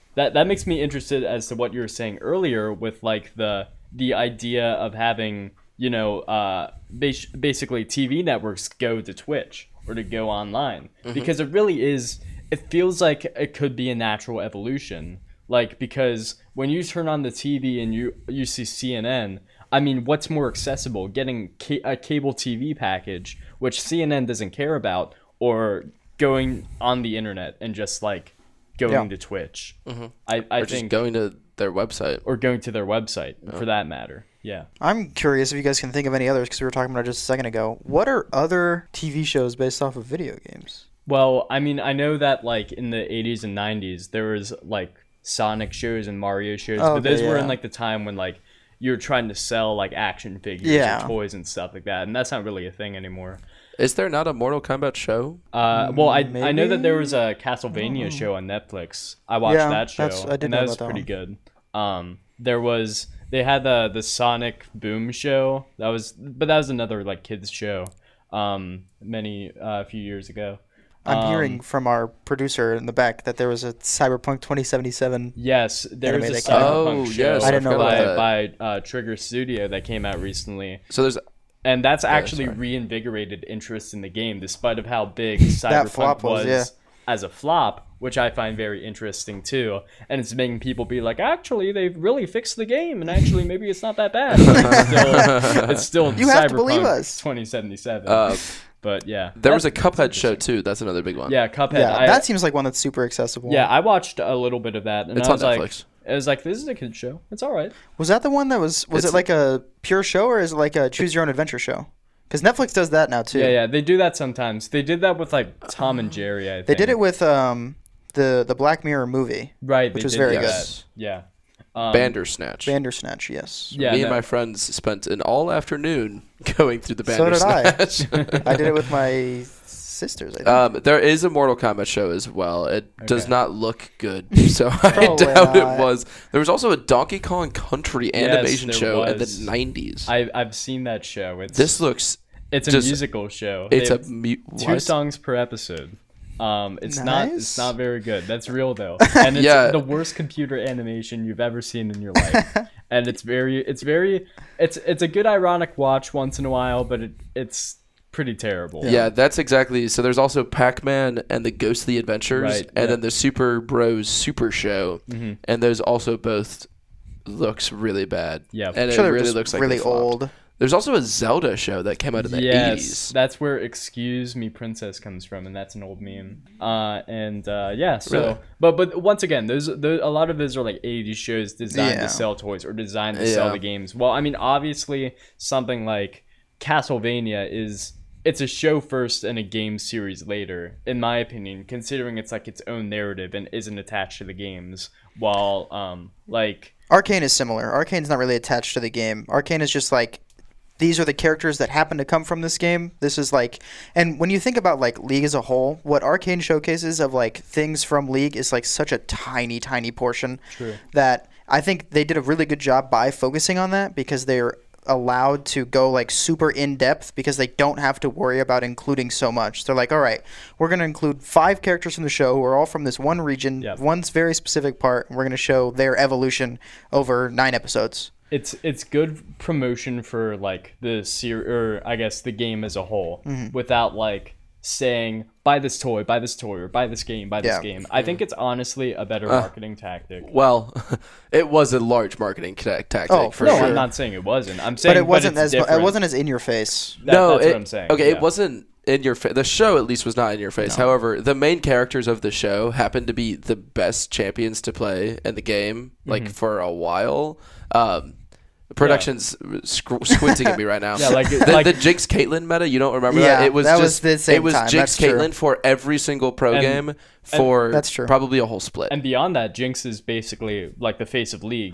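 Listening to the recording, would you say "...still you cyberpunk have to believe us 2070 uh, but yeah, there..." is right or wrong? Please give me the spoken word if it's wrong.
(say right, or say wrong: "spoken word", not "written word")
wrong: "2077", not "2070".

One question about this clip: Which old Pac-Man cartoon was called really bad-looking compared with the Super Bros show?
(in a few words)
Pac-Man and the Ghostly Adventures.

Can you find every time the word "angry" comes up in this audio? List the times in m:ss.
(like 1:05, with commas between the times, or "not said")
not said.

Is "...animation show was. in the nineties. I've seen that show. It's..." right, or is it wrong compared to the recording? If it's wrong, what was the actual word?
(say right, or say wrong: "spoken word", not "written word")
right.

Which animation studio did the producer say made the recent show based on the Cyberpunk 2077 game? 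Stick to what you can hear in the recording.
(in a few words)
Trigger Studio.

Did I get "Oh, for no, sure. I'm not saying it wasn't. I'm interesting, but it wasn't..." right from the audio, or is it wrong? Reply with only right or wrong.
wrong.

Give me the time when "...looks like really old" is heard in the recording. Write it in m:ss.
2:49.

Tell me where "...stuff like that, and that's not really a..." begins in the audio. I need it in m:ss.
0:51.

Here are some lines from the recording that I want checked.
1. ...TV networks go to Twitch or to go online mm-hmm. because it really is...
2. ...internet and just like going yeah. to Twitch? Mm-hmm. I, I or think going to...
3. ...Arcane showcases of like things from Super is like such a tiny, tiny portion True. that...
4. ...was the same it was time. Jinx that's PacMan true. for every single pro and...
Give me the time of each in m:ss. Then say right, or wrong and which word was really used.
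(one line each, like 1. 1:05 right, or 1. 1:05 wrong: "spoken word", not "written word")
1. 0:07 right
2. 0:27 right
3. 3:26 wrong: "League", not "Super"
4. 4:23 wrong: "Caitlyn", not "PacMan".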